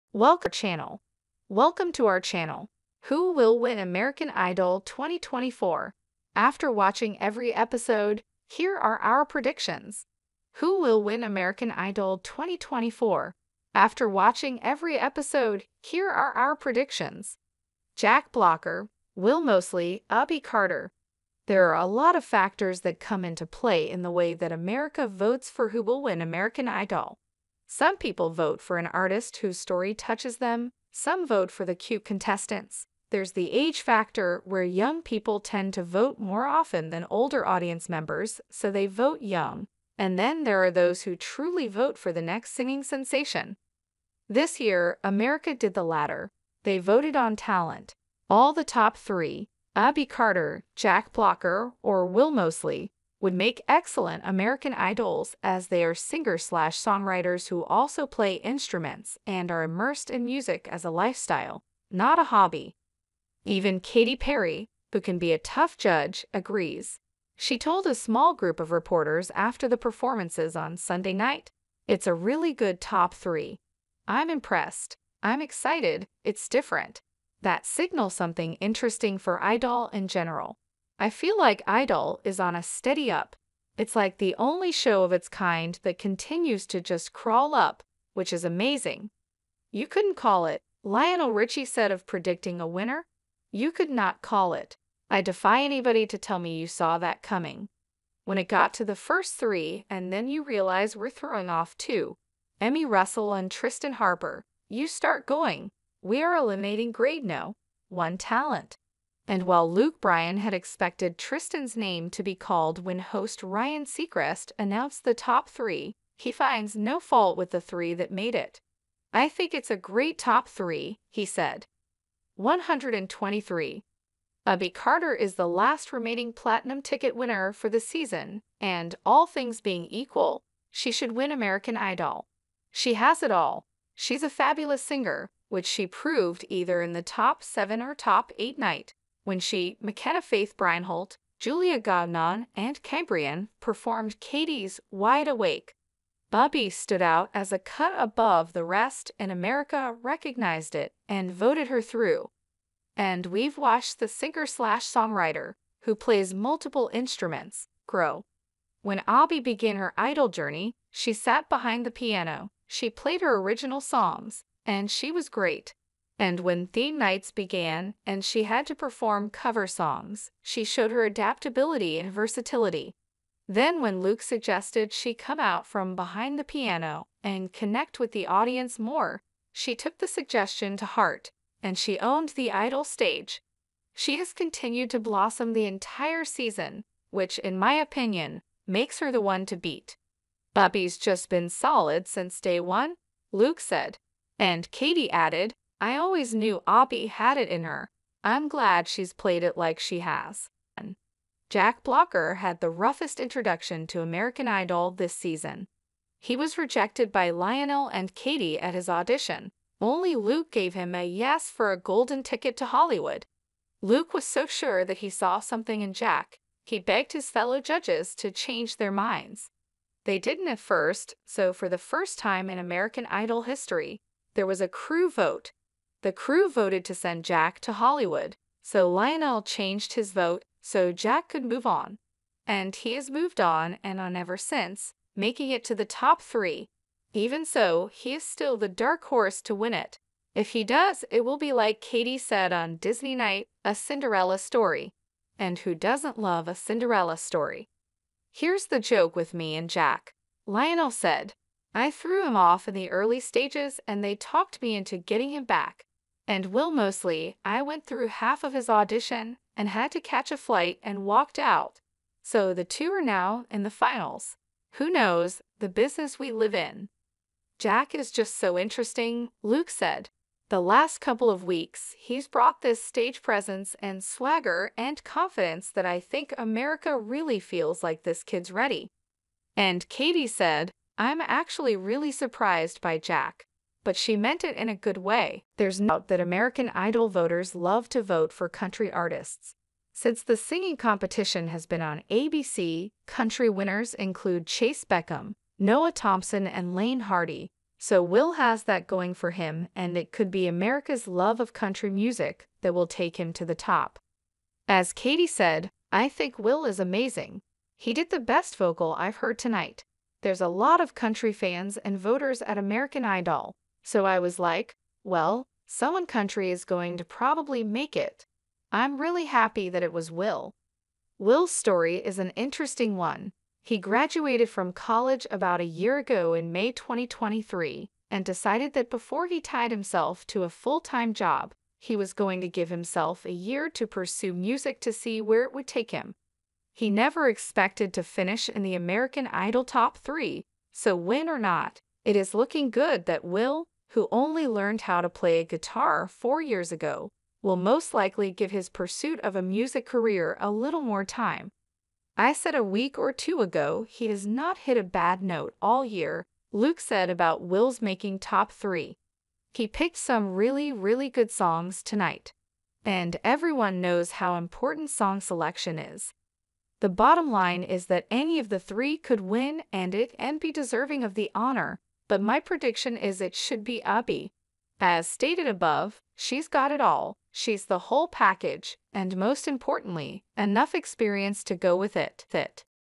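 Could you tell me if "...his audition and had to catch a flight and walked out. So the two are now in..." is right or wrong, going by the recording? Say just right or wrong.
right.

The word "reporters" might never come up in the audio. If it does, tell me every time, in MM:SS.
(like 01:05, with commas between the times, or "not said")
01:08.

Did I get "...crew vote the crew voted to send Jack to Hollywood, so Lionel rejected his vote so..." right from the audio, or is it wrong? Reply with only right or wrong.
wrong.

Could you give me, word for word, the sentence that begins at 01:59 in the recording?
I think it's a great top three, he said.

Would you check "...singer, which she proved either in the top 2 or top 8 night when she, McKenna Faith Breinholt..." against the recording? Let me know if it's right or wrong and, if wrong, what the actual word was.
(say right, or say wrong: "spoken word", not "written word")
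wrong: "7", not "2".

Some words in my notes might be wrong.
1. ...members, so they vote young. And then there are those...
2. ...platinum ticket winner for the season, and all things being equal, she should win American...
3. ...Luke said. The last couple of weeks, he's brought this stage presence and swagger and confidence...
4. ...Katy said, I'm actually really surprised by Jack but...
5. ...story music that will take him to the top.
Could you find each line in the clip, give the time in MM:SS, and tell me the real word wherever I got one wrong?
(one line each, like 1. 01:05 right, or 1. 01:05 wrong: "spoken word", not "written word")
1. 00:37 right
2. 02:06 right
3. 04:29 right
4. 04:39 right
5. 05:01 wrong: "country", not "story".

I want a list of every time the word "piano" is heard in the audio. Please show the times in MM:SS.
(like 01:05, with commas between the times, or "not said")
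02:41, 02:56.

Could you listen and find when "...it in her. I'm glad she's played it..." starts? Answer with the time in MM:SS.
03:17.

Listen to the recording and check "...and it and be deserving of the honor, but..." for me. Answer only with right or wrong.
right.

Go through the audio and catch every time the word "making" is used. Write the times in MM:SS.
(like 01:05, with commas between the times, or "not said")
03:55, 05:57.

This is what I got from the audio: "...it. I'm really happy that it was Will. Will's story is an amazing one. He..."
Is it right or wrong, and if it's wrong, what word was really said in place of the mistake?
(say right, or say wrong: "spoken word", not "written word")
wrong: "interesting", not "amazing".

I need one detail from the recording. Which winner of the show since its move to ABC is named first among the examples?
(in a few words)
Chayce Beckham.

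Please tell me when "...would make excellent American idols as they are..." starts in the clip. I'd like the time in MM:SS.
00:53.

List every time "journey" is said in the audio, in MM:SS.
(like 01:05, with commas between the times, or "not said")
02:40.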